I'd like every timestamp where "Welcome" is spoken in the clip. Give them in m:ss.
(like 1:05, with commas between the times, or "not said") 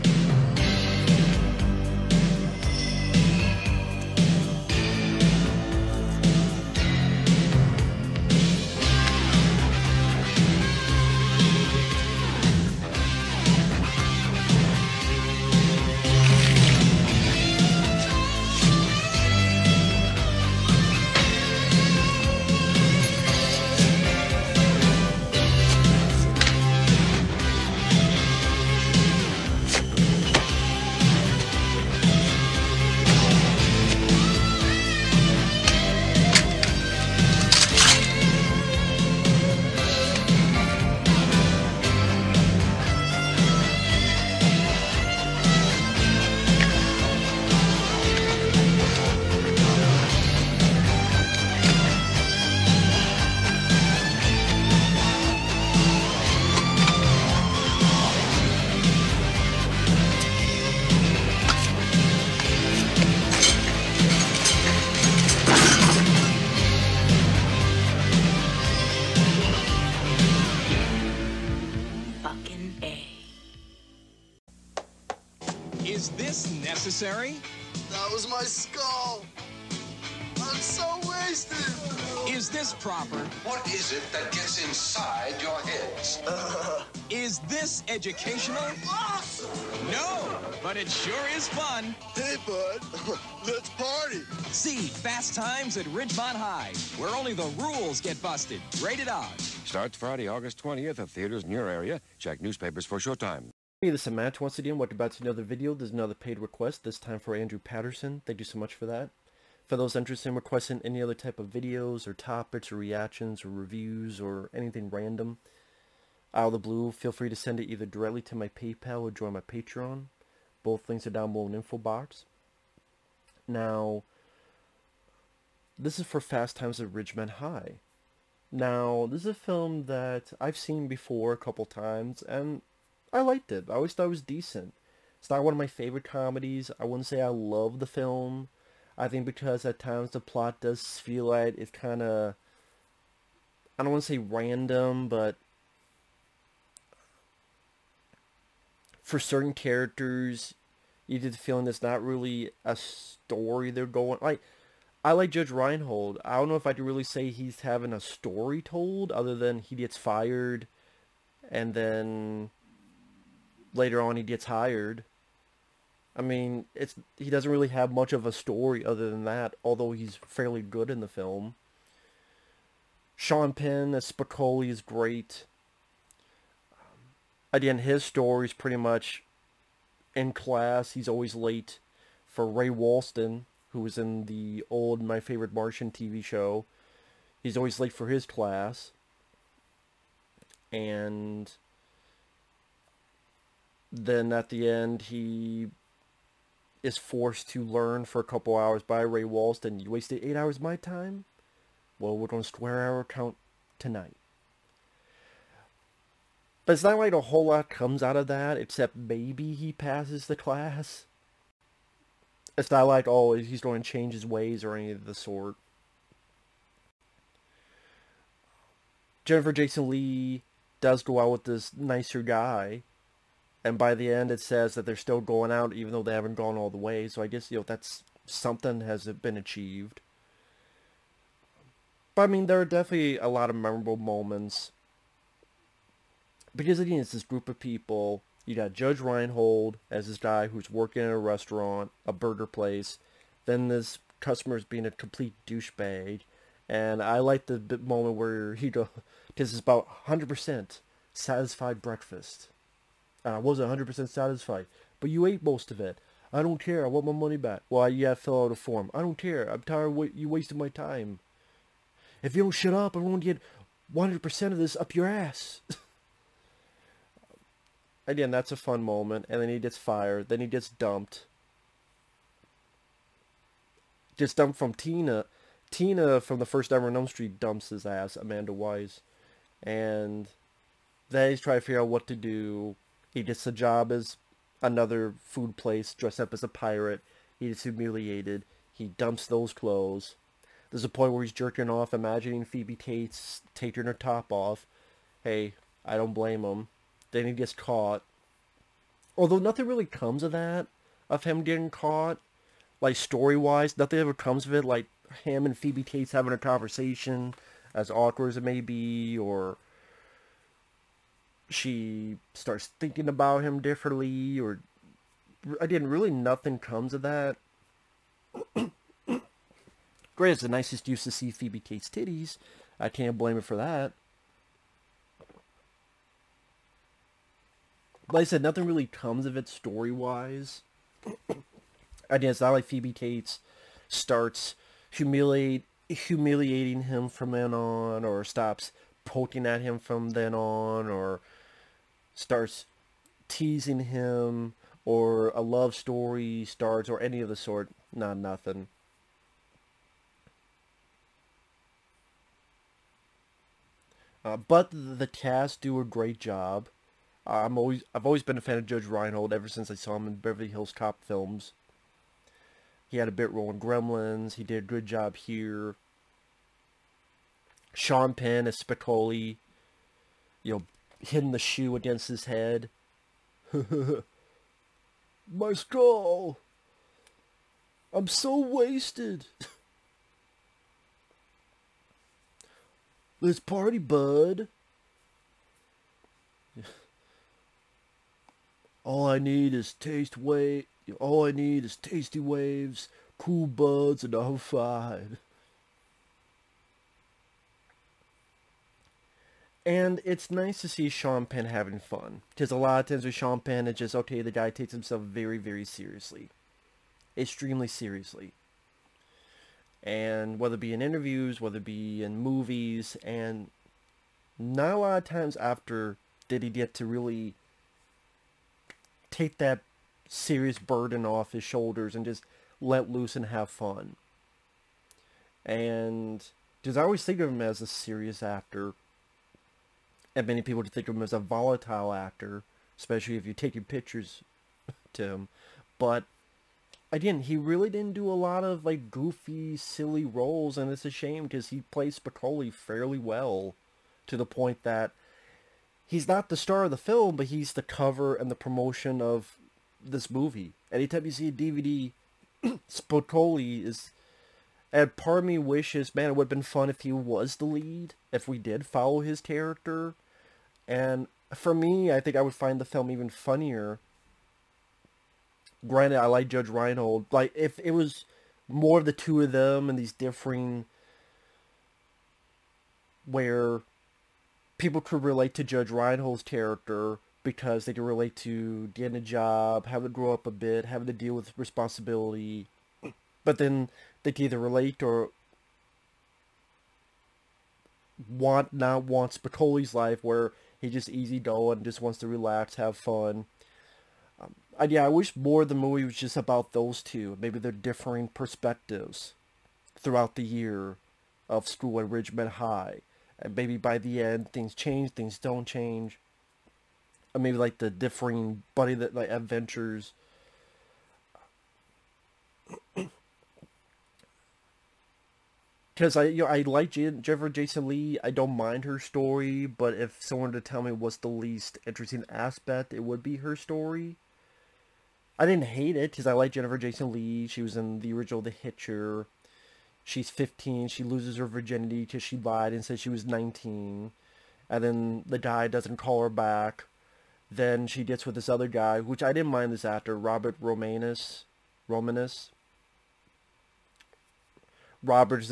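1:44.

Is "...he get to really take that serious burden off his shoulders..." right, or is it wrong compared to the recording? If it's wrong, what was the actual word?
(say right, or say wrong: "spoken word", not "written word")
right.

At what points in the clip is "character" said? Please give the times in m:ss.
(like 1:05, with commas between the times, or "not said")
2:29, 7:39, 7:56.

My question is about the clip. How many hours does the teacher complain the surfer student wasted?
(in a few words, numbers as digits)
8.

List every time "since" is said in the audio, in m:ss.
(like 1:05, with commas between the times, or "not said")
5:59.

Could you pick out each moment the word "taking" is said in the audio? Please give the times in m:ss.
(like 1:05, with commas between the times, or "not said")
4:53, 7:13.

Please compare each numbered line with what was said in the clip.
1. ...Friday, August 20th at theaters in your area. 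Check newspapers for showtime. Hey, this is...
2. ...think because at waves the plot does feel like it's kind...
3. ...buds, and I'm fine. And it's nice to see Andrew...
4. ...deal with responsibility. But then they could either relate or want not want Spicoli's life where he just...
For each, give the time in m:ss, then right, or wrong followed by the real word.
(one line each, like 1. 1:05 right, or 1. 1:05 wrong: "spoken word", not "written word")
1. 1:39 right
2. 2:19 wrong: "times", not "waves"
3. 6:33 wrong: "Sean", not "Andrew"
4. 8:00 right.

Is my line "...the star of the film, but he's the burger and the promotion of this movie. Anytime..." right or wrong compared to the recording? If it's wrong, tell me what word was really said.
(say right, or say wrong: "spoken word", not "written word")
wrong: "cover", not "burger".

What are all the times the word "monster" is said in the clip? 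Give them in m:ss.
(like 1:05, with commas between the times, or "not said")
not said.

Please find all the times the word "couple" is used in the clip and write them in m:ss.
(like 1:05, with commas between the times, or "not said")
2:11, 3:18.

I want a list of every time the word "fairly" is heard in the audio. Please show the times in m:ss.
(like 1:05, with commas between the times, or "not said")
2:50, 7:22.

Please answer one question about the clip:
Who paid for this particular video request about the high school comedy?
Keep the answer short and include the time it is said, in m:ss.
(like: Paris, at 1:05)
Andrew Patterson, at 1:47.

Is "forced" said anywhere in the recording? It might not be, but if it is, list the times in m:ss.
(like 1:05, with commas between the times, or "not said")
3:16.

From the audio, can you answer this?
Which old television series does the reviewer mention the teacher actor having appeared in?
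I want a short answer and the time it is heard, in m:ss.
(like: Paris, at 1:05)
My Favorite Martian, at 3:05.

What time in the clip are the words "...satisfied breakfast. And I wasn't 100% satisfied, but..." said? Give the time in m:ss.
4:11.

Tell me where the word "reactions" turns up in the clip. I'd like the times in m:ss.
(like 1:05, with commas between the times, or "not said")
1:52.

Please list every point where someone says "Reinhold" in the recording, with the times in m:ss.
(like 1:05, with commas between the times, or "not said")
2:35, 3:58, 5:58, 7:46, 7:55.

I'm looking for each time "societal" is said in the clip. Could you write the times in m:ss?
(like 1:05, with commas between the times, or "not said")
not said.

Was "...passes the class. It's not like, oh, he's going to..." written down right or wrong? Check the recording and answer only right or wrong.
right.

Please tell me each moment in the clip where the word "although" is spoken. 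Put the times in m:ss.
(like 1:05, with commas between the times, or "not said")
2:49, 4:59.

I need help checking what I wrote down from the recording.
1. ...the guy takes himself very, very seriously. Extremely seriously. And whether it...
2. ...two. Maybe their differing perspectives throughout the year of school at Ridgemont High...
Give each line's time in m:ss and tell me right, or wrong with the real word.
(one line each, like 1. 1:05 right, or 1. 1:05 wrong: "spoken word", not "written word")
1. 6:44 right
2. 8:16 right.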